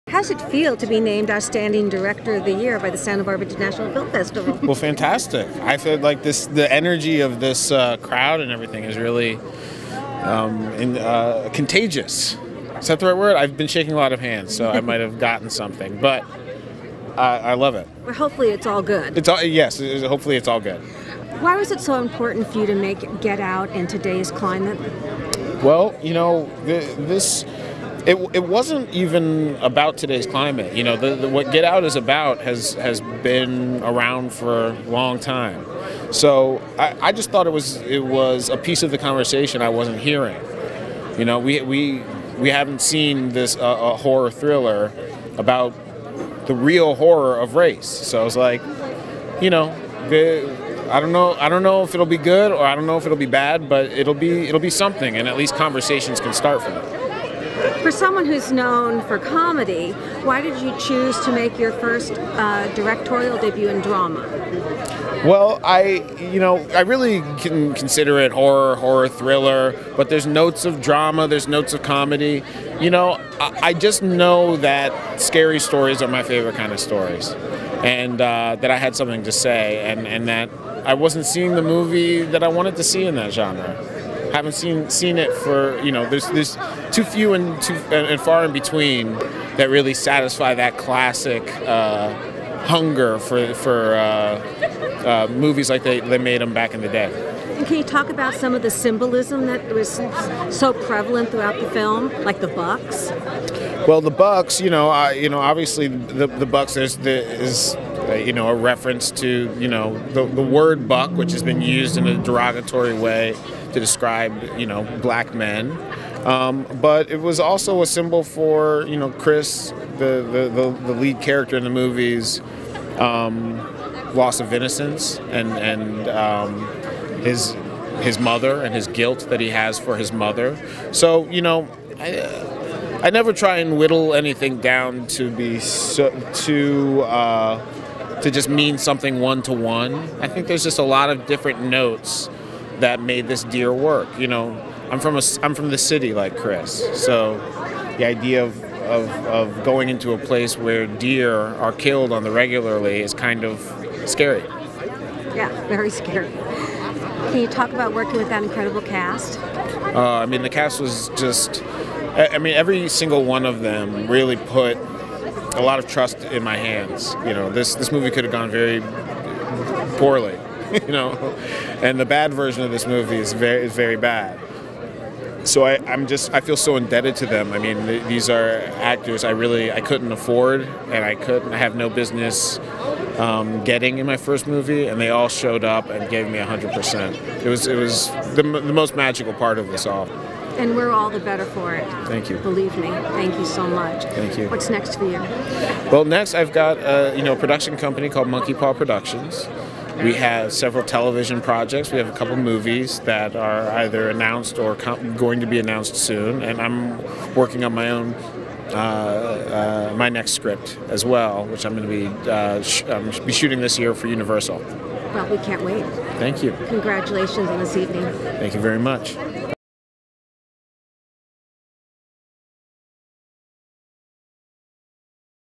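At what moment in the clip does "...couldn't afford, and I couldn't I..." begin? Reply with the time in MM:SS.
02:59.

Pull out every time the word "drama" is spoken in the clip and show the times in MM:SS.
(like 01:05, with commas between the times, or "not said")
01:03, 01:10.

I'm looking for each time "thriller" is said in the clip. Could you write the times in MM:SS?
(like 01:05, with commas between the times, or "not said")
00:44, 01:09.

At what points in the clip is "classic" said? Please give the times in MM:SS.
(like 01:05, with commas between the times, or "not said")
01:30.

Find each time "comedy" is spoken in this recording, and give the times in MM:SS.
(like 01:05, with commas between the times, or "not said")
00:59, 01:11.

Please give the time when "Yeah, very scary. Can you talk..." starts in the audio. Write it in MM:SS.
02:35.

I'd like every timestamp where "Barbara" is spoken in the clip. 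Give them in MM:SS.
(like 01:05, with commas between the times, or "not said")
00:03.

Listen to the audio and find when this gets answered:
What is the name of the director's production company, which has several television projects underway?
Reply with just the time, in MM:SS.
03:18.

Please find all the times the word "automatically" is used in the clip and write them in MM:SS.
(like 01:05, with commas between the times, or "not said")
not said.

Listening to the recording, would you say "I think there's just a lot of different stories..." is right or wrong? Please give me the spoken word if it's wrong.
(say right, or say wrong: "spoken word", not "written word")
wrong: "notes", not "stories".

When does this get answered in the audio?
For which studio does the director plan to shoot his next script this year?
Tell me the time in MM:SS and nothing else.
03:34.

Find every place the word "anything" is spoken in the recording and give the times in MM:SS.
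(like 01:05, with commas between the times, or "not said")
02:14.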